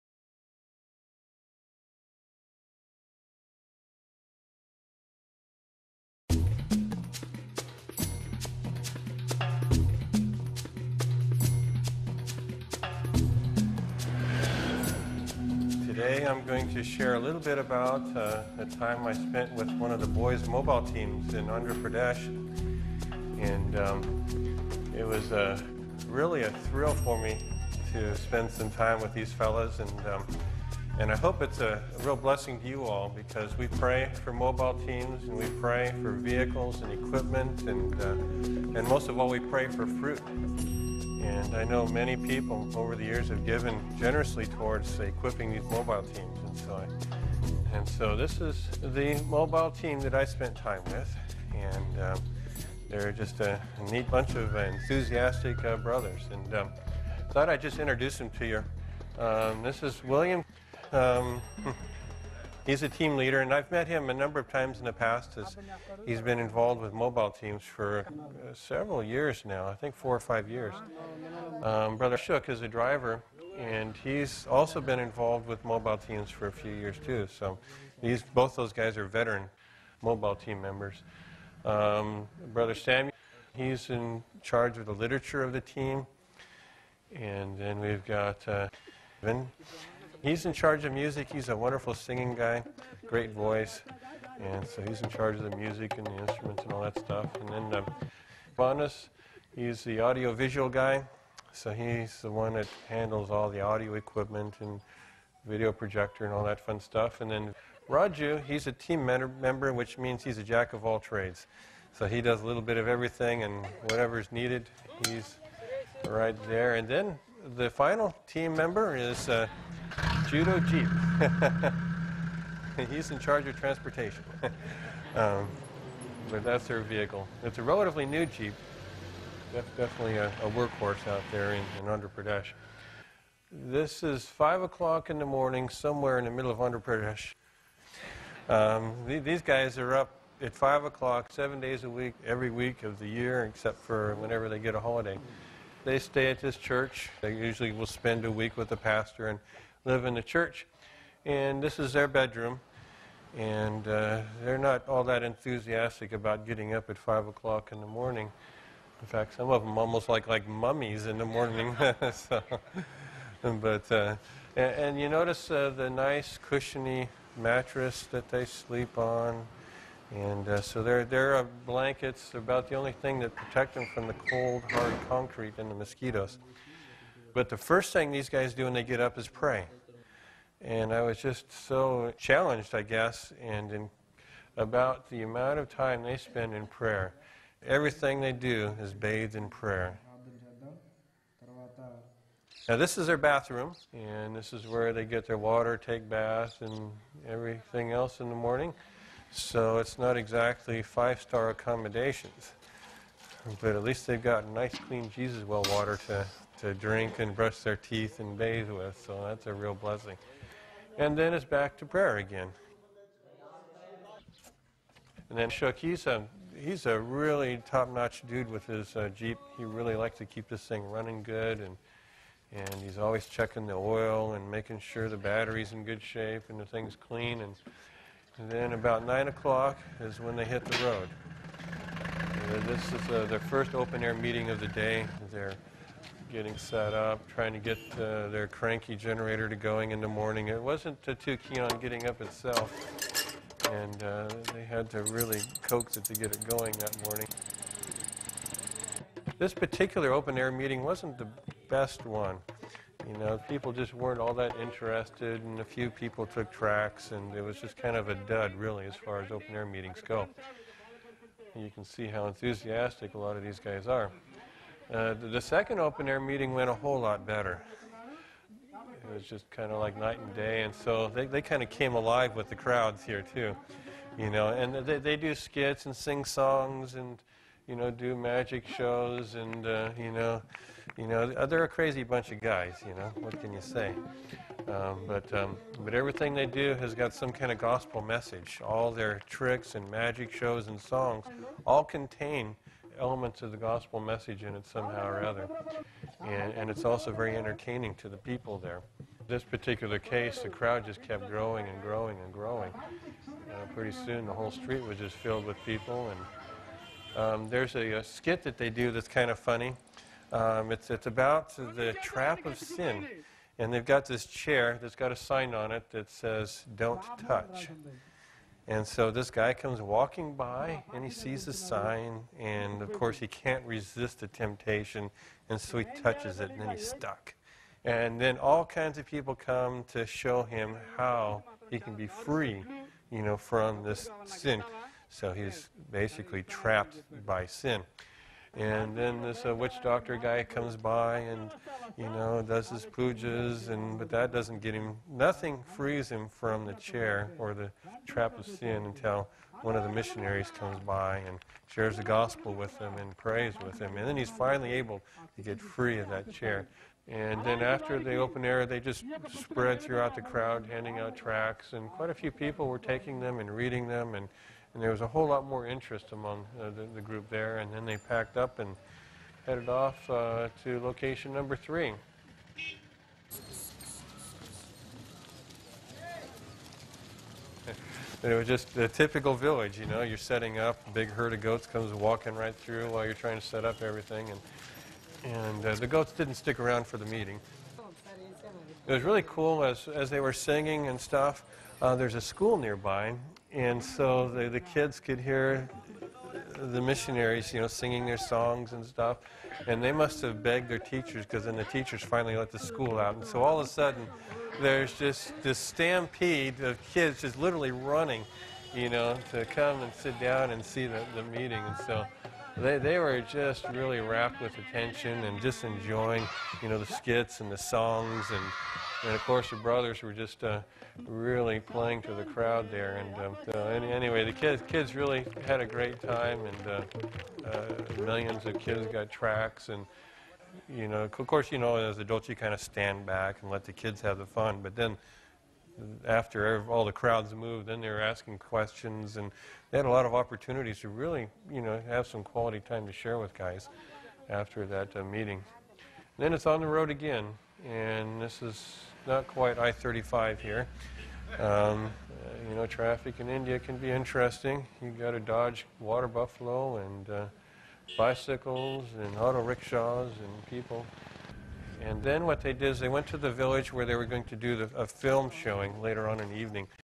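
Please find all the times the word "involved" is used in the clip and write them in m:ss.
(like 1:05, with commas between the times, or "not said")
1:06, 1:14.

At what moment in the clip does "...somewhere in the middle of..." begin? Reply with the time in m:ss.
2:15.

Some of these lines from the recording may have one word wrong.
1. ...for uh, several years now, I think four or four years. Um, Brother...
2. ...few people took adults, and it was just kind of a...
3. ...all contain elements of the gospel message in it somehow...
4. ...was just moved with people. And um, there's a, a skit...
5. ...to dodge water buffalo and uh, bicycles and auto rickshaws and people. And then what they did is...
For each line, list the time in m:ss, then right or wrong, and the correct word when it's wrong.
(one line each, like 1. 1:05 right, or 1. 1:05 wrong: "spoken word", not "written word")
1. 1:07 wrong: "five", not "four"
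2. 4:15 wrong: "tracts", not "adults"
3. 4:51 right
4. 5:04 wrong: "filled", not "moved"
5. 7:35 right.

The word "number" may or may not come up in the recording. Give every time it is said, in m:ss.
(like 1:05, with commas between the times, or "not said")
1:04, 6:11.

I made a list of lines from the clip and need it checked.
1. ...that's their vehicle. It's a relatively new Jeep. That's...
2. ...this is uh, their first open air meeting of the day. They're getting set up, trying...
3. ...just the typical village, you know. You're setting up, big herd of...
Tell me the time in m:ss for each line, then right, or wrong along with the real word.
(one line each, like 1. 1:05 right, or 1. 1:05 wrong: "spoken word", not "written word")
1. 2:06 right
2. 3:52 right
3. 6:18 right.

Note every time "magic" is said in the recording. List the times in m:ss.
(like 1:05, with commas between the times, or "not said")
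4:38, 4:49.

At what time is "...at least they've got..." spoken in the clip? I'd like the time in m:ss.
3:23.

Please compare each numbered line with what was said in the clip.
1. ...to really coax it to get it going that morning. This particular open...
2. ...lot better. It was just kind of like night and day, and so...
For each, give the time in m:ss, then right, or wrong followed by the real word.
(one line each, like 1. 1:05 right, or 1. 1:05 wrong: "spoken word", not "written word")
1. 4:04 right
2. 4:26 right.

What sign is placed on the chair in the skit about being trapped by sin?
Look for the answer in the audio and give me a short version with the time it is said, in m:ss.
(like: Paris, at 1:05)
Don't touch, at 5:16.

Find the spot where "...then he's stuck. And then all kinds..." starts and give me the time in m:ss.
5:26.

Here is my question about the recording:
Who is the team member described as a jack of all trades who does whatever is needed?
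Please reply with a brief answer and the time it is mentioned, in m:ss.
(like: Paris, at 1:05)
Raju, at 1:47.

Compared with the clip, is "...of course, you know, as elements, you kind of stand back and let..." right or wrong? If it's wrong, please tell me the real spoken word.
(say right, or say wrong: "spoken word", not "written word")
wrong: "adults", not "elements".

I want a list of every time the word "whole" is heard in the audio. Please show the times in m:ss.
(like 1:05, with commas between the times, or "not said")
4:26, 5:04, 6:05.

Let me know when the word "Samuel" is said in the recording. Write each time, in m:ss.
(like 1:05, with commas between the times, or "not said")
1:22.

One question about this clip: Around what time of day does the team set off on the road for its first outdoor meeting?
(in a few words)
9 o'clock.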